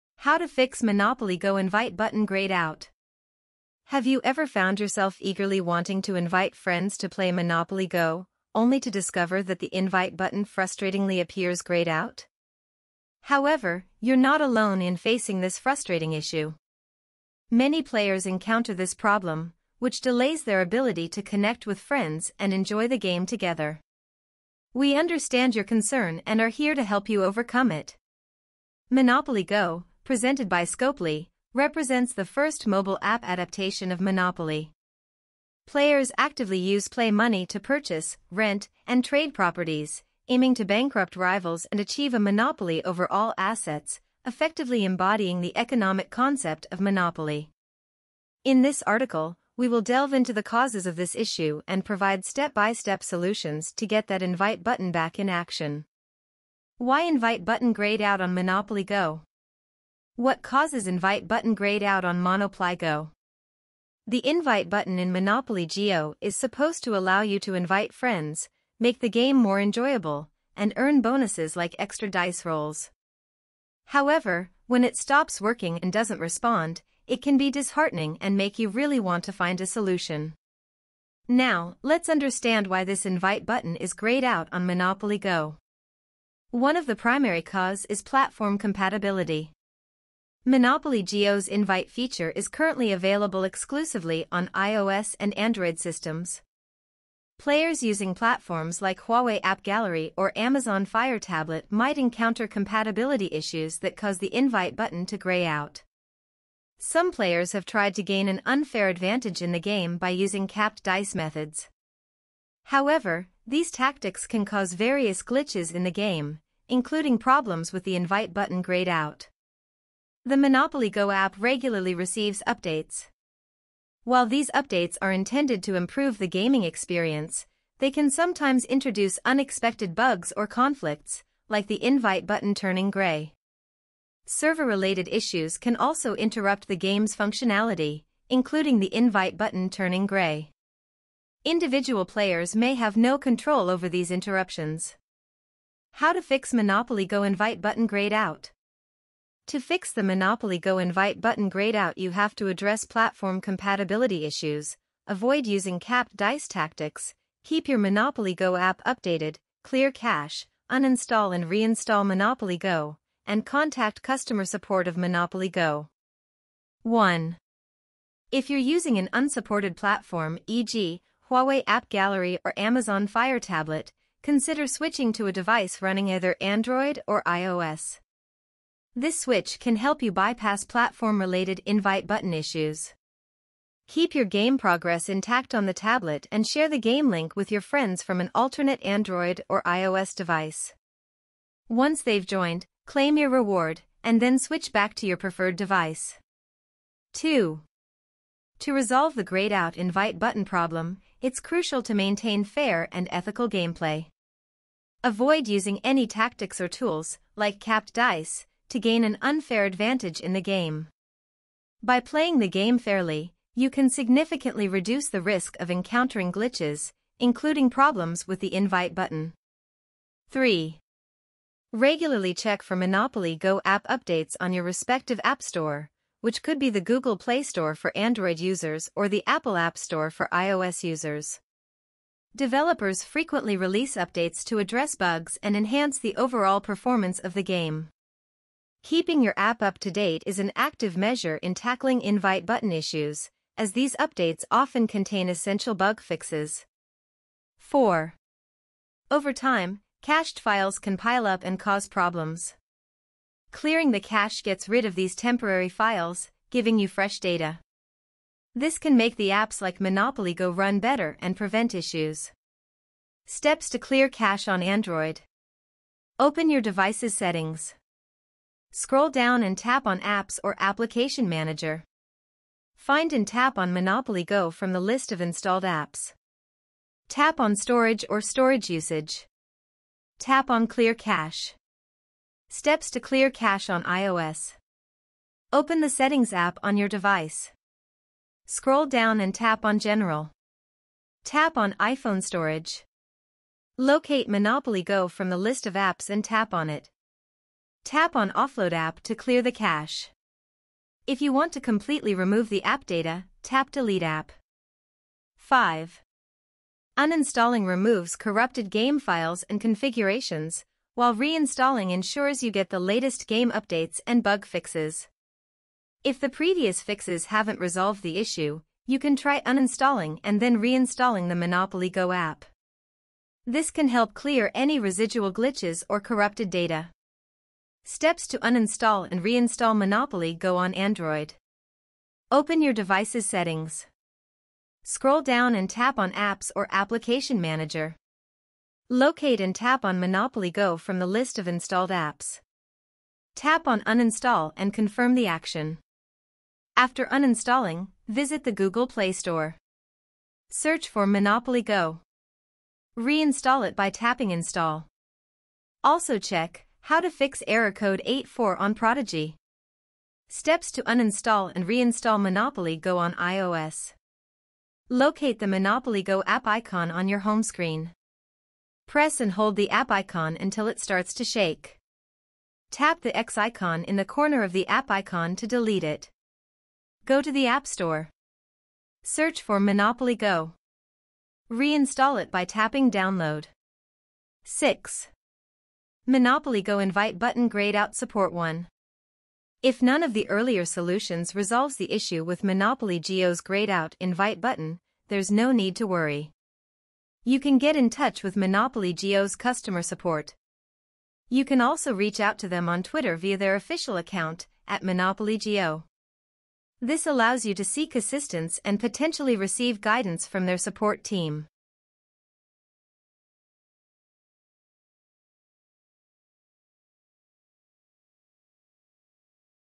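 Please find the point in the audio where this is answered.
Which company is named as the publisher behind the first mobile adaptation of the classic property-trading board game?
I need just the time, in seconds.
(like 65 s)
30 s.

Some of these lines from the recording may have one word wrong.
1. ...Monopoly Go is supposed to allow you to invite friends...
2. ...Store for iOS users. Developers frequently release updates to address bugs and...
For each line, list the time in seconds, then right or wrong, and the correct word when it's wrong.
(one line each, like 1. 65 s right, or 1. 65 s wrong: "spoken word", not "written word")
1. 65 s right
2. 229 s right.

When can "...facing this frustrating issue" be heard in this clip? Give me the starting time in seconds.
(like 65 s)
14 s.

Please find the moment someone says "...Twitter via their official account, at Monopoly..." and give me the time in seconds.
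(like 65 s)
402 s.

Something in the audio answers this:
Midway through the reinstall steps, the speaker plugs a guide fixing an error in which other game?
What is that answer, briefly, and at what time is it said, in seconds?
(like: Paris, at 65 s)
Prodigy, at 358 s.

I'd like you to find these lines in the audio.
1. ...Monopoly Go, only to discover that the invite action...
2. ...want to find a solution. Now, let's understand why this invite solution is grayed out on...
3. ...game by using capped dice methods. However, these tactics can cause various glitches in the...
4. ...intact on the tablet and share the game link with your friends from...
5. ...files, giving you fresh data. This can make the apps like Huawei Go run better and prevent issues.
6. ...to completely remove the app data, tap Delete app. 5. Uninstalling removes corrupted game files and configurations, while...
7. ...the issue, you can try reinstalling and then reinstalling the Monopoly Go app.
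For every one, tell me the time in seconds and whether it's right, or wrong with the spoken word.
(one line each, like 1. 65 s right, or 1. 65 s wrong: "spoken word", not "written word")
1. 7 s wrong: "button", not "action"
2. 78 s wrong: "button", not "solution"
3. 109 s right
4. 185 s right
5. 255 s wrong: "Monopoly", not "Huawei"
6. 301 s right
7. 318 s wrong: "uninstalling", not "reinstalling".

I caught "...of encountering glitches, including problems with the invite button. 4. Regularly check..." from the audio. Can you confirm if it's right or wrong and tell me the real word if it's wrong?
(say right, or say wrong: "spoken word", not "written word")
wrong: "3", not "4".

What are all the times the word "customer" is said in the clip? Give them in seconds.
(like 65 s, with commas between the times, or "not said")
164 s, 399 s.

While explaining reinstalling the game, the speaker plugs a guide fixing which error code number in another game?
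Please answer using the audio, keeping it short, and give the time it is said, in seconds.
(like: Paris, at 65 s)
84, at 358 s.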